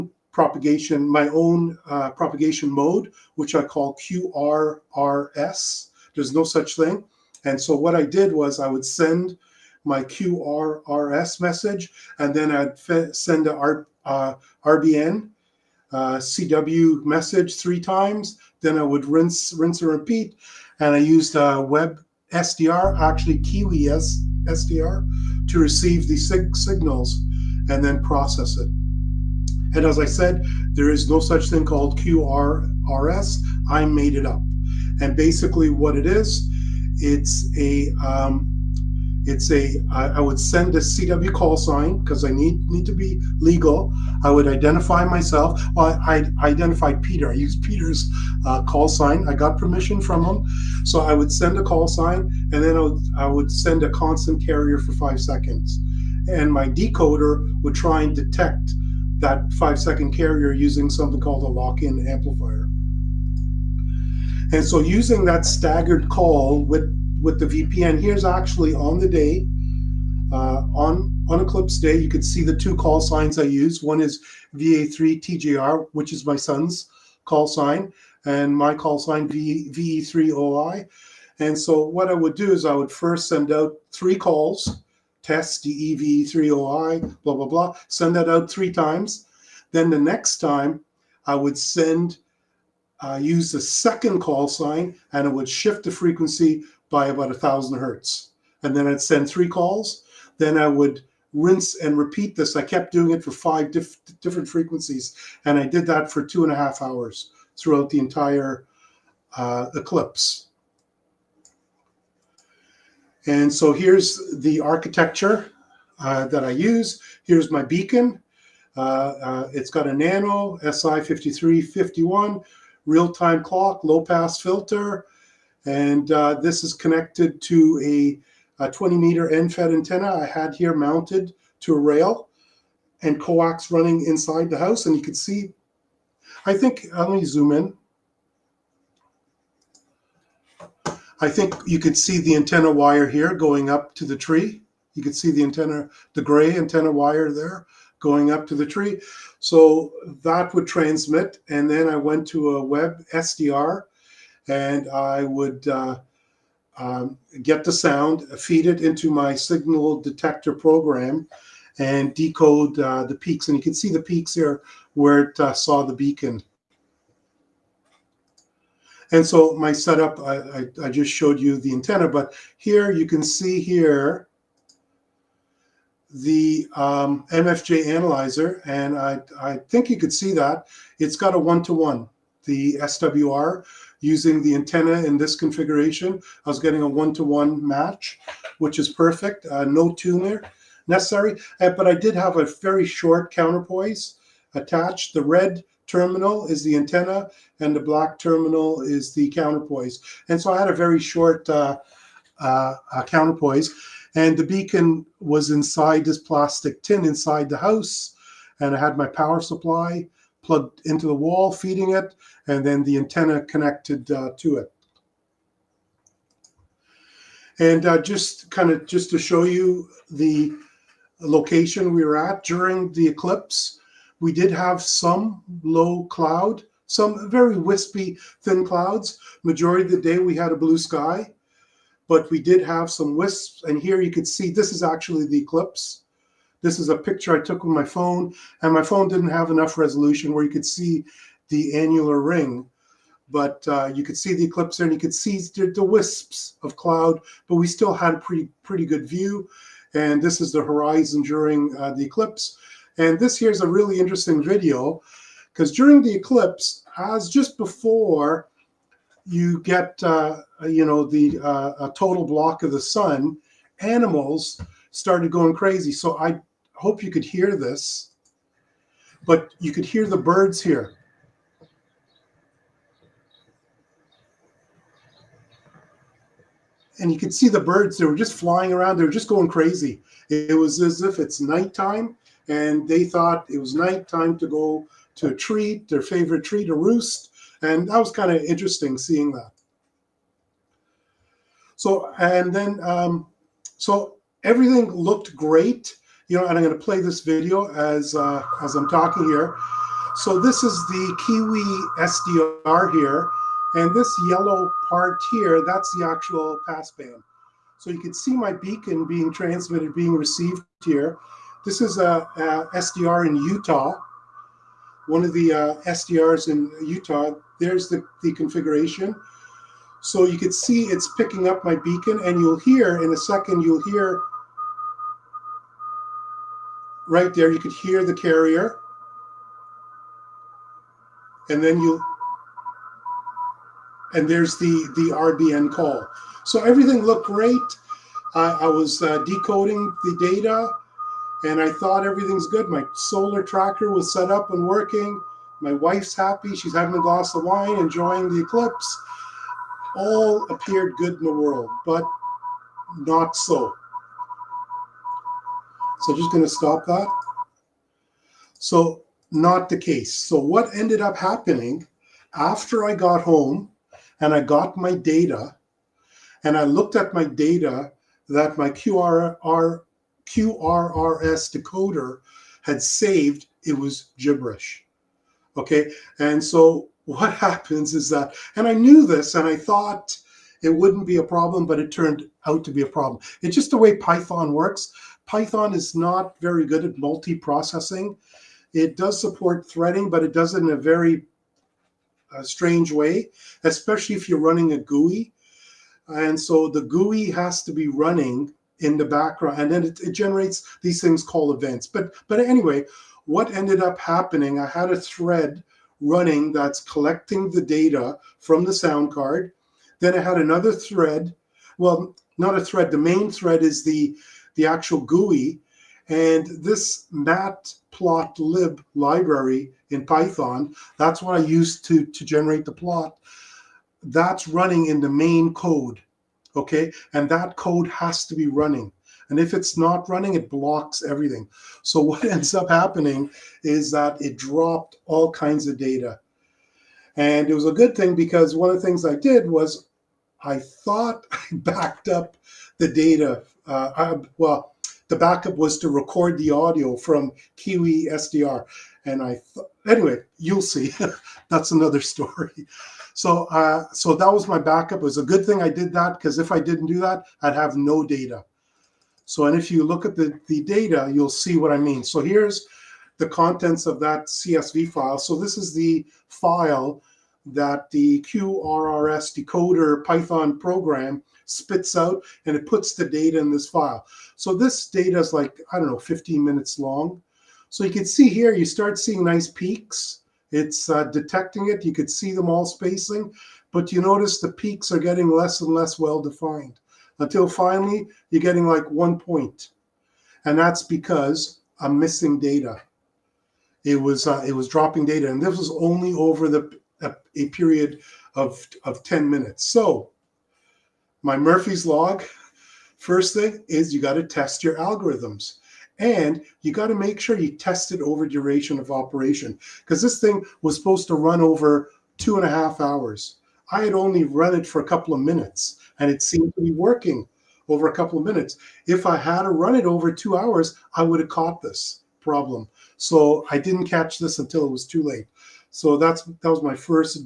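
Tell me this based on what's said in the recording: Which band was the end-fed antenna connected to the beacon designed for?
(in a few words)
20 meter.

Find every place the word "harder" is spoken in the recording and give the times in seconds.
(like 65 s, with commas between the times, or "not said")
not said.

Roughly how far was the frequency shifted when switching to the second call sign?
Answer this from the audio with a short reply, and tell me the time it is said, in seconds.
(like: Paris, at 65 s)
1,000 hertz, at 97 s.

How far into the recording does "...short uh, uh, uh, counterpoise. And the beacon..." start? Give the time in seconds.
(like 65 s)
200 s.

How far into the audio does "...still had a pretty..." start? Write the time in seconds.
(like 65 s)
247 s.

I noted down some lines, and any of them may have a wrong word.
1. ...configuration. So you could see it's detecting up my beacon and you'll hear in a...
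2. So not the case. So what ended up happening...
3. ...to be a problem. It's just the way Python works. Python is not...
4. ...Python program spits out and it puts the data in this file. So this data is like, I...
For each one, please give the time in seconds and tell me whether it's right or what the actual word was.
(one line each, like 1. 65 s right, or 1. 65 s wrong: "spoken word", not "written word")
1. 318 s wrong: "picking", not "detecting"
2. 358 s right
3. 382 s right
4. 470 s right.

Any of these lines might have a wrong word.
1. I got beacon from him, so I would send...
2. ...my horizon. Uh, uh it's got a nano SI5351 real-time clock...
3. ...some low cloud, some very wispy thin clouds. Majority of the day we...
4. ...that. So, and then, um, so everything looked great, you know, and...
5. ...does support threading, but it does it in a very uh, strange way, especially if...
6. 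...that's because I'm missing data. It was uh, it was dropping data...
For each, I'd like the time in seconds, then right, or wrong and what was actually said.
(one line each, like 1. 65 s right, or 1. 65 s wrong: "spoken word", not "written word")
1. 49 s wrong: "permission", not "beacon"
2. 117 s wrong: "beacon", not "horizon"
3. 224 s right
4. 289 s right
5. 388 s right
6. 490 s right.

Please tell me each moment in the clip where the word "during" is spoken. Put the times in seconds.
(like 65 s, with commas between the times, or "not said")
222 s, 251 s, 255 s.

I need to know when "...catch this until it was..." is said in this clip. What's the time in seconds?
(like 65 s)
523 s.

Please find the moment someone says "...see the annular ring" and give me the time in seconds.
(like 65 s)
240 s.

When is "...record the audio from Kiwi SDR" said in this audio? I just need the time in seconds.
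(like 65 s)
445 s.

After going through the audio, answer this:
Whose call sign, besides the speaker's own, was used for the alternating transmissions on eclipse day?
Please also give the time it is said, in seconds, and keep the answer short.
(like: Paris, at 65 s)
VA3TGR, at 74 s.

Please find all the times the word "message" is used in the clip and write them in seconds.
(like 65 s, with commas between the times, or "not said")
11 s, 17 s.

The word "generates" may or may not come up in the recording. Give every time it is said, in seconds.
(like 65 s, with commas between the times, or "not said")
400 s, 422 s.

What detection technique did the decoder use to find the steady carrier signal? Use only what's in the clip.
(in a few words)
lock-in amplifier.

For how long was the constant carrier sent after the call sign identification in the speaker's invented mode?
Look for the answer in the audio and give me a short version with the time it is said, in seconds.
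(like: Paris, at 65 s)
5 seconds, at 54 s.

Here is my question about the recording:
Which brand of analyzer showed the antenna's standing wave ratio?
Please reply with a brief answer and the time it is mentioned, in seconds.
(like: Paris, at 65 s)
MFJ, at 177 s.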